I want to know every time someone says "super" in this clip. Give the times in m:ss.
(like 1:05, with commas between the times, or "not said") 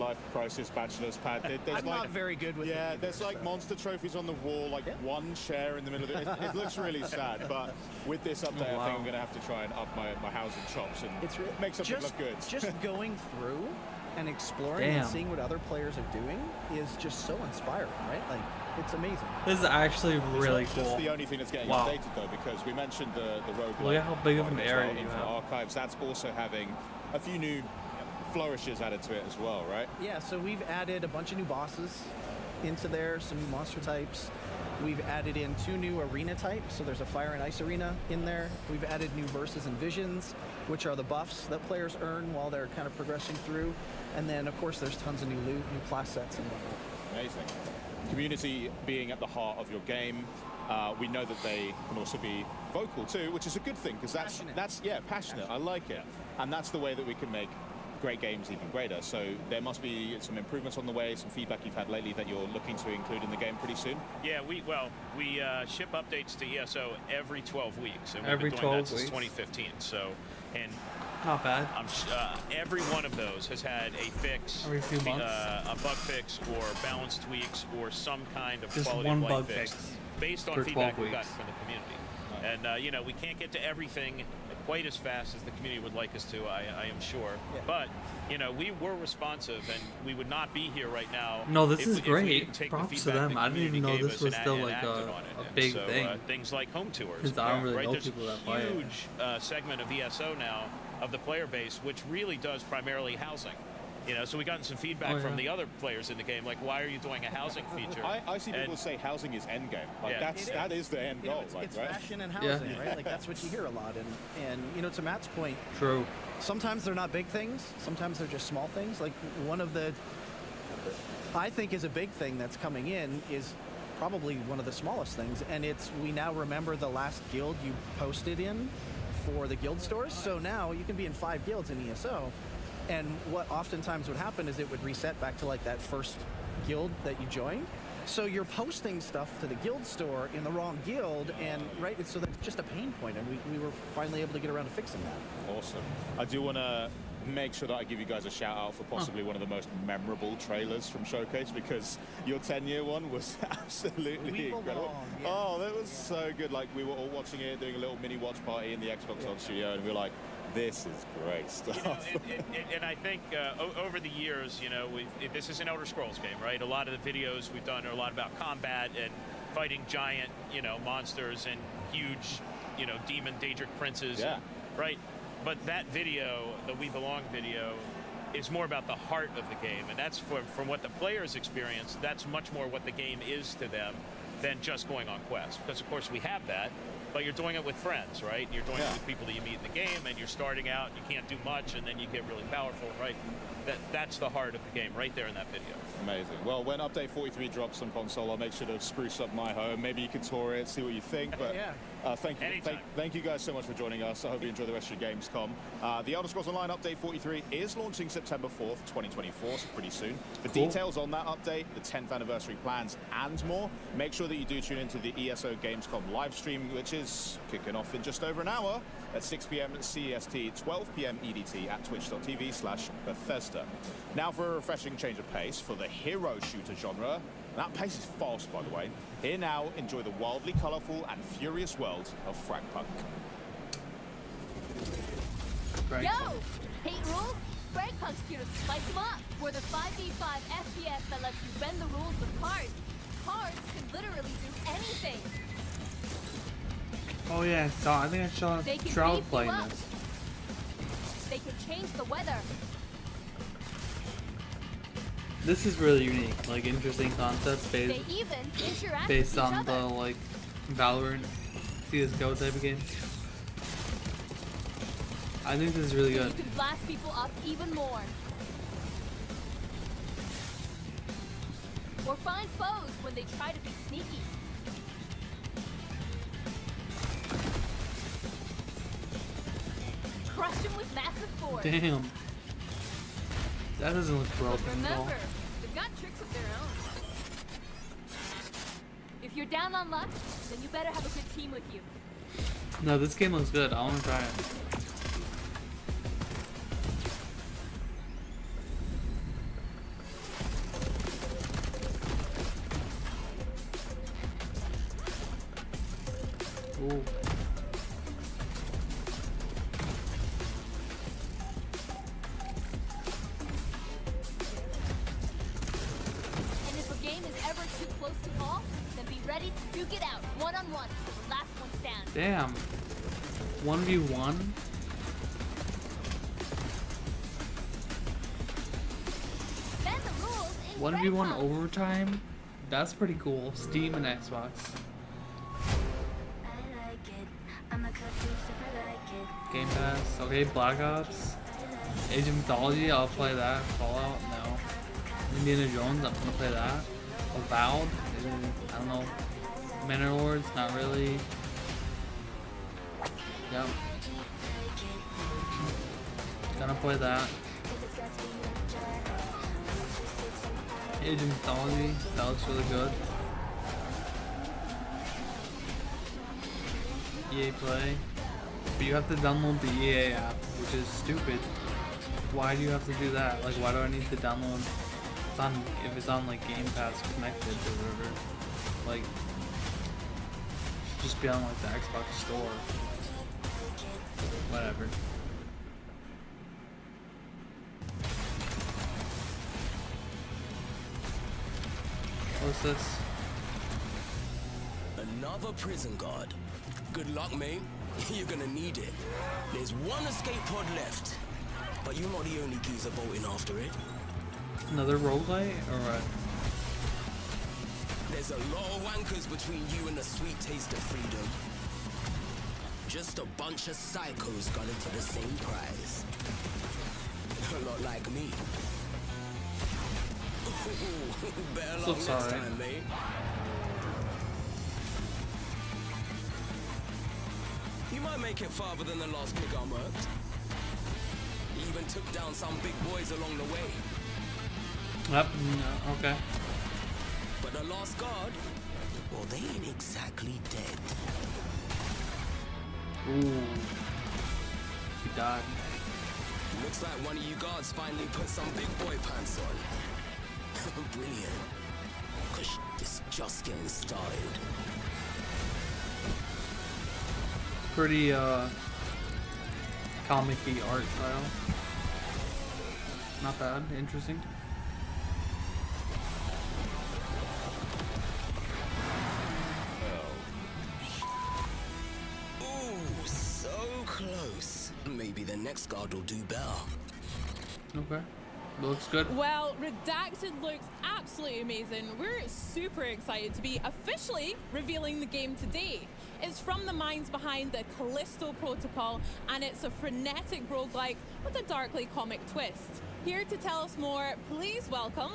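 8:02.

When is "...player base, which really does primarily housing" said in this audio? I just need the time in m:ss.
1:41.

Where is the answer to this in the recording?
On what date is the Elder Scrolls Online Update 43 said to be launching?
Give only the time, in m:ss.
3:28.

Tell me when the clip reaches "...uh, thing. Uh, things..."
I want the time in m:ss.
1:35.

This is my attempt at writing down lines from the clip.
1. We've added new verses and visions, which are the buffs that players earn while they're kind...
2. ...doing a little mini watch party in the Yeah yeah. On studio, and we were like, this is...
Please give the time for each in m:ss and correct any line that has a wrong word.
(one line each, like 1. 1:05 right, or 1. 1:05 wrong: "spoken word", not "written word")
1. 0:38 right
2. 2:37 wrong: "Xbox", not "Yeah".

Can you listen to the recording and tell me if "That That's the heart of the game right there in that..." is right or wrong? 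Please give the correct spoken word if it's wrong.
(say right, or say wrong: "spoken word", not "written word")
right.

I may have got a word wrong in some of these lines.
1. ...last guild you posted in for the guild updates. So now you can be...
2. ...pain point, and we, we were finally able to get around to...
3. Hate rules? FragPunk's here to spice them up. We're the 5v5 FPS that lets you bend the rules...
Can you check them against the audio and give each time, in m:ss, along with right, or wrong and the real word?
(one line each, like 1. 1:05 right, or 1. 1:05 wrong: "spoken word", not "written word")
1. 2:06 wrong: "stores", not "updates"
2. 2:22 right
3. 3:56 right.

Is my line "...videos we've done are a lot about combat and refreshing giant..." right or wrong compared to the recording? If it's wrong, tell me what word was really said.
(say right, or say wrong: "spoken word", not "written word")
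wrong: "fighting", not "refreshing".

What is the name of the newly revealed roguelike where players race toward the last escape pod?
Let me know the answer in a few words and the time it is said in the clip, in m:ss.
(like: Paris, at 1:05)
Redacted, at 7:59.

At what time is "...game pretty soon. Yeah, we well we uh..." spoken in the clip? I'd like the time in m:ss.
1:03.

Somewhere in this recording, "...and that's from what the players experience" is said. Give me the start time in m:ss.
2:59.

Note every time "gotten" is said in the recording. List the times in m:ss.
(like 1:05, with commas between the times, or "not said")
1:21, 1:44.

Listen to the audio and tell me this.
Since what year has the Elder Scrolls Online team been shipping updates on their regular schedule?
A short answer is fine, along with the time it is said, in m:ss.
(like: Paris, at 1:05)
2015, at 1:09.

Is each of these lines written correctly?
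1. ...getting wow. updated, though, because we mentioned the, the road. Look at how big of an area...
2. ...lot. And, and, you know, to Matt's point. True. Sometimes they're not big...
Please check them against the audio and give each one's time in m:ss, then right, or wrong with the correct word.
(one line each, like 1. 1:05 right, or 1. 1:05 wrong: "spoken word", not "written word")
1. 0:21 right
2. 1:53 right.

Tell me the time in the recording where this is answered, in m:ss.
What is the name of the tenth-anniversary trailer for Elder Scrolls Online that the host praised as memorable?
2:56.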